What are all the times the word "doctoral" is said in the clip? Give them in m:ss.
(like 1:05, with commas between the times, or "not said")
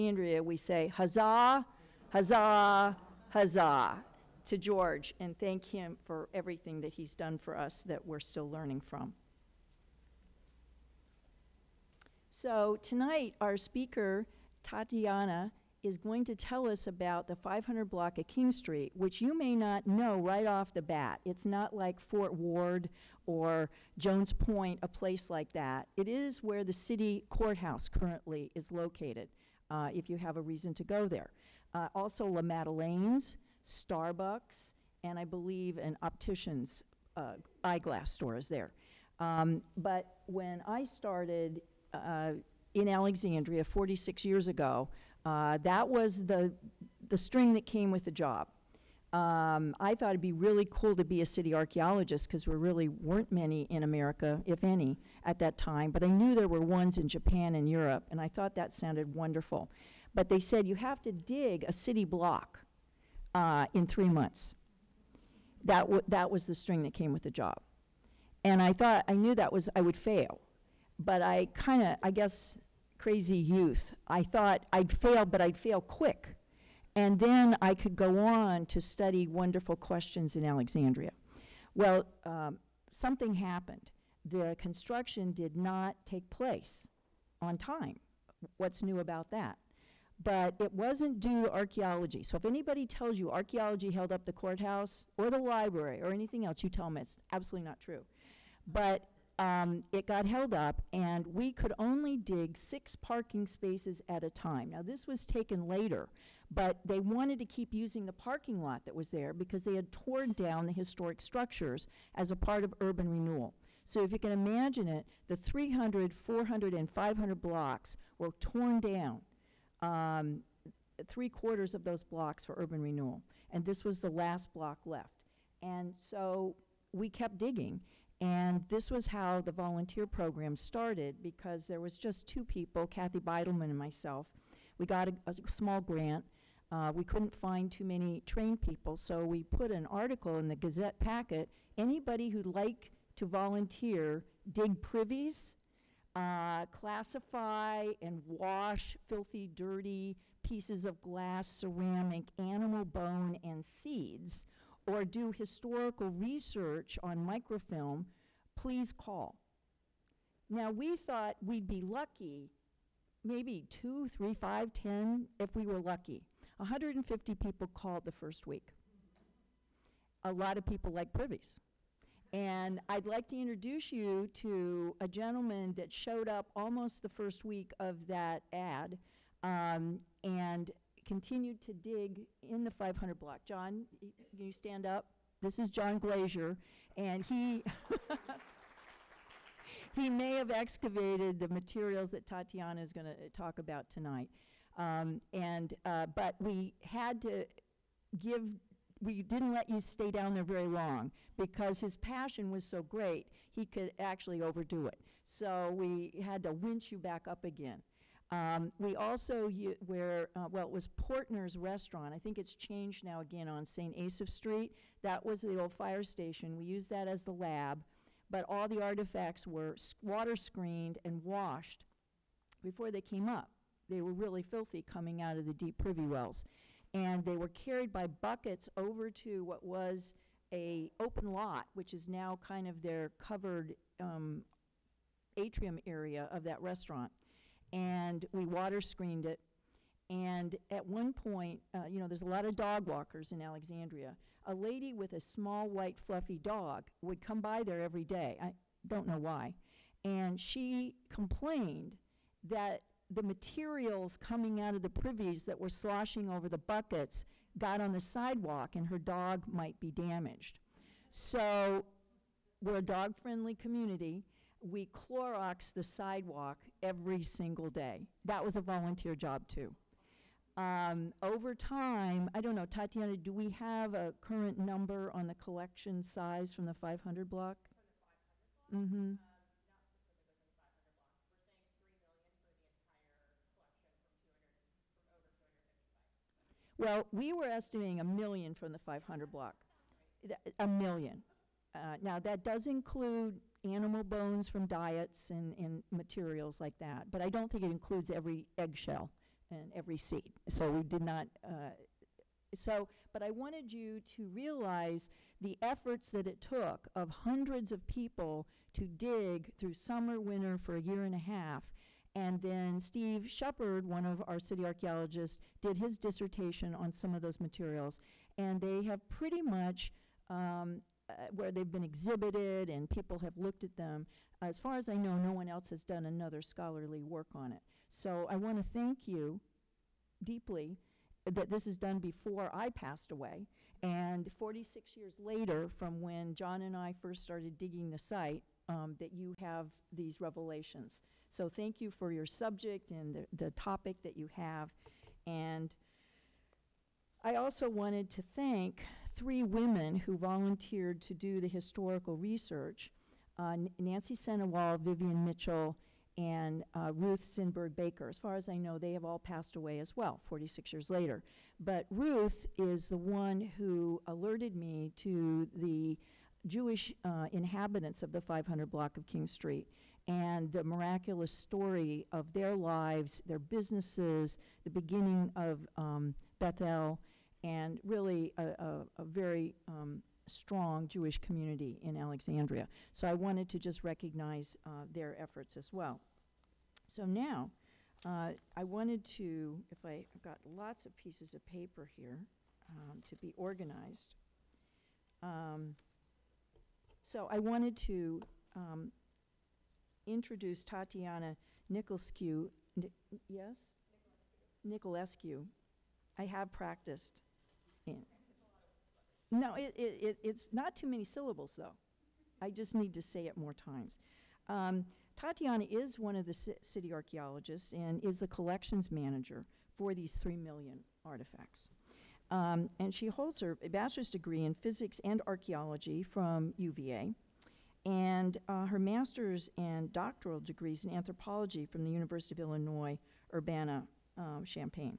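7:09.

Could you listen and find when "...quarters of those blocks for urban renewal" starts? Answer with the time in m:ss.
2:01.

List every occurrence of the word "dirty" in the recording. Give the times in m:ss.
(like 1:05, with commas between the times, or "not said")
2:29.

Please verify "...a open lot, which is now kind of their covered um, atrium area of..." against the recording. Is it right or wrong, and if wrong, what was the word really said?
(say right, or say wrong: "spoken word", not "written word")
right.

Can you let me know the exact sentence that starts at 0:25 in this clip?
It is where the city courthouse currently is located, uh, if you have a reason to go there.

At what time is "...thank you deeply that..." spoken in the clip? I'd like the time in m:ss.
5:28.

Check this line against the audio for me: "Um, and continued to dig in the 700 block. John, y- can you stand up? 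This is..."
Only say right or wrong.
wrong.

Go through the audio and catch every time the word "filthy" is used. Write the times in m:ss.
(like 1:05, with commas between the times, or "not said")
2:29, 3:44.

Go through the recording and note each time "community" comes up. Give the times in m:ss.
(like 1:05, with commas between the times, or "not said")
4:23, 6:21.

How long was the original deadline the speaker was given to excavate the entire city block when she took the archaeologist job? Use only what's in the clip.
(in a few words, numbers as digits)
3 months.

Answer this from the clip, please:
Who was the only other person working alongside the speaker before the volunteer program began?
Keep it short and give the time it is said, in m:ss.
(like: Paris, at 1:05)
Kathy Beidelman, at 2:12.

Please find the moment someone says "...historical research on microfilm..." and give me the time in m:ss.
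2:35.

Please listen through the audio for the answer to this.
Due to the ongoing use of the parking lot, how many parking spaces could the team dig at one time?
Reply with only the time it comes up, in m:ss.
1:42.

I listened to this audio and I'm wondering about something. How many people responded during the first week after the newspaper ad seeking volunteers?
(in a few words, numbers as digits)
150.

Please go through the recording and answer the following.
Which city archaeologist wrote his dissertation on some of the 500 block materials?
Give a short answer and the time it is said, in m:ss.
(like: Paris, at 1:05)
Steve Shephard, at 5:12.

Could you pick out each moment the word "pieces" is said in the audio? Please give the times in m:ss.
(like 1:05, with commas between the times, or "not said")
2:30, 6:30.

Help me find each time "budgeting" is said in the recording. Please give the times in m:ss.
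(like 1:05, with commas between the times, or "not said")
not said.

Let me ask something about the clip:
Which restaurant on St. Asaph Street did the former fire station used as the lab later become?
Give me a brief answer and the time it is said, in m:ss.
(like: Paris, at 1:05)
Portner's Restaurant, at 3:30.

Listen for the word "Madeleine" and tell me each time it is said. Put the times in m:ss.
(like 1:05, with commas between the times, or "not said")
0:32.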